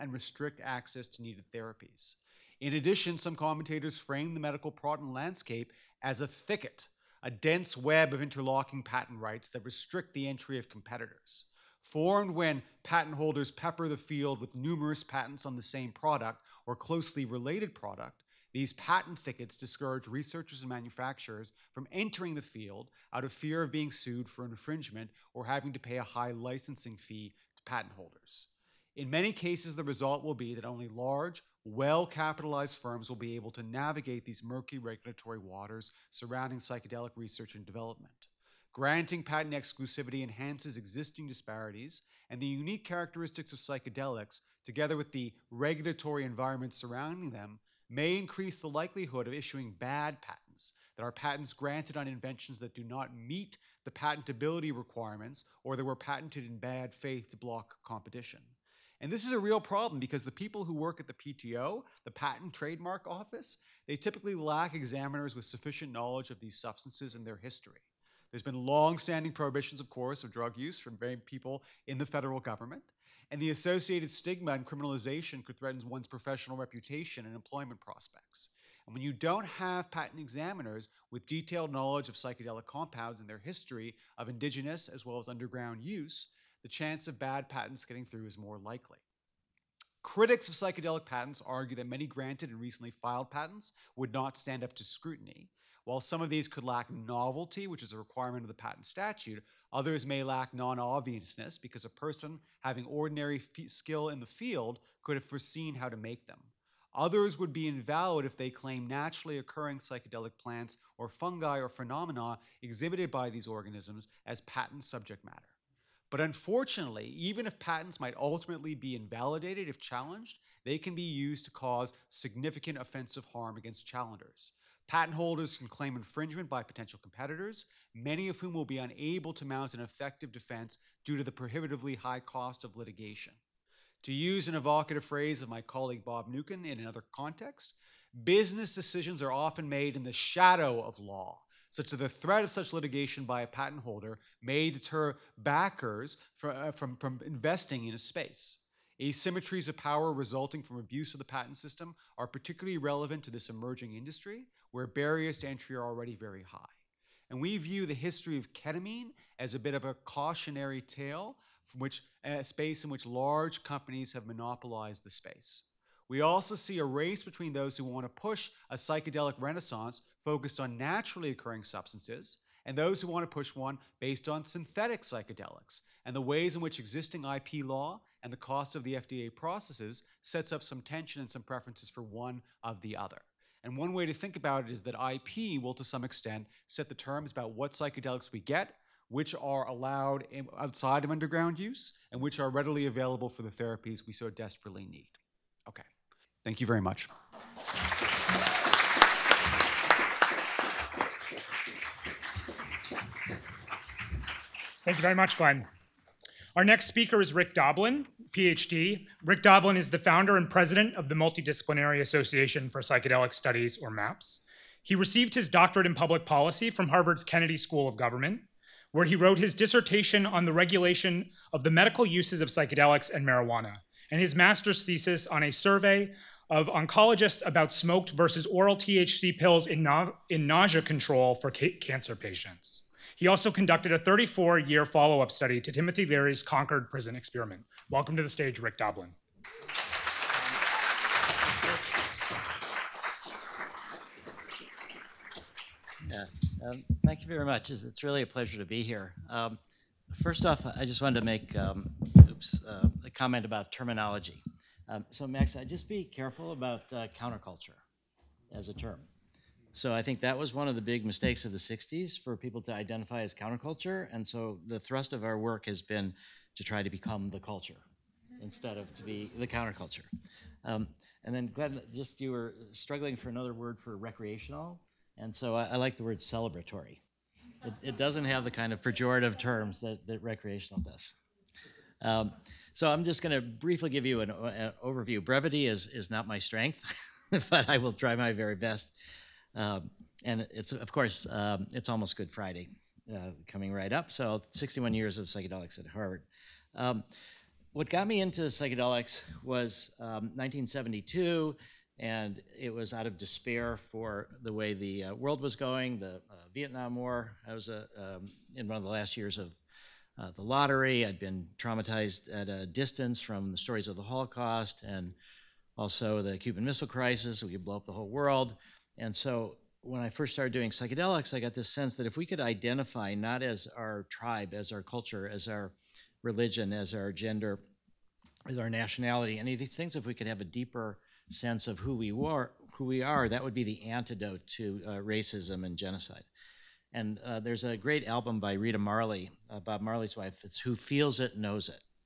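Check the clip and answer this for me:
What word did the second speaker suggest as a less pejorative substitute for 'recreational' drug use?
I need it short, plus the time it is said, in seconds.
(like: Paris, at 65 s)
celebratory, at 276 s.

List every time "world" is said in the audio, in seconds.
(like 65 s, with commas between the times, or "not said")
305 s, 318 s.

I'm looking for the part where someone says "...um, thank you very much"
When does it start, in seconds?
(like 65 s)
246 s.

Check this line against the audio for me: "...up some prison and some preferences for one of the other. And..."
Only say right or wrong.
wrong.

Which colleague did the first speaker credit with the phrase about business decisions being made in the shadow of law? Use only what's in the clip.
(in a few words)
Bob Mnookin.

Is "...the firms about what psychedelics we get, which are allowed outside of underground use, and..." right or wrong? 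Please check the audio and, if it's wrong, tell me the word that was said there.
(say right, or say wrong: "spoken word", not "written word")
wrong: "terms", not "firms".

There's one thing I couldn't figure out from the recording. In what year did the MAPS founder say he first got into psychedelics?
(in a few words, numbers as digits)
1972.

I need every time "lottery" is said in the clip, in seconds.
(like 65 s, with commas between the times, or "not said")
310 s.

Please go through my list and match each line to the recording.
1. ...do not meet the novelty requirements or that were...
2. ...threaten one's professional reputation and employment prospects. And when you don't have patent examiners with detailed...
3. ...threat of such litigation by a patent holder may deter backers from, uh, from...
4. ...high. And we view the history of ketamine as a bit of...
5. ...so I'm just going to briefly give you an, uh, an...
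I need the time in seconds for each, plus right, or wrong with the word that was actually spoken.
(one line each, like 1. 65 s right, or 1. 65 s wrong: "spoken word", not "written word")
1. 52 s wrong: "patentability", not "novelty"
2. 75 s right
3. 142 s right
4. 156 s right
5. 282 s right.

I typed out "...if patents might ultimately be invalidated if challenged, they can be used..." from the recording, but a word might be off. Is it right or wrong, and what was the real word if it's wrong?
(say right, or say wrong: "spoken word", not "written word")
right.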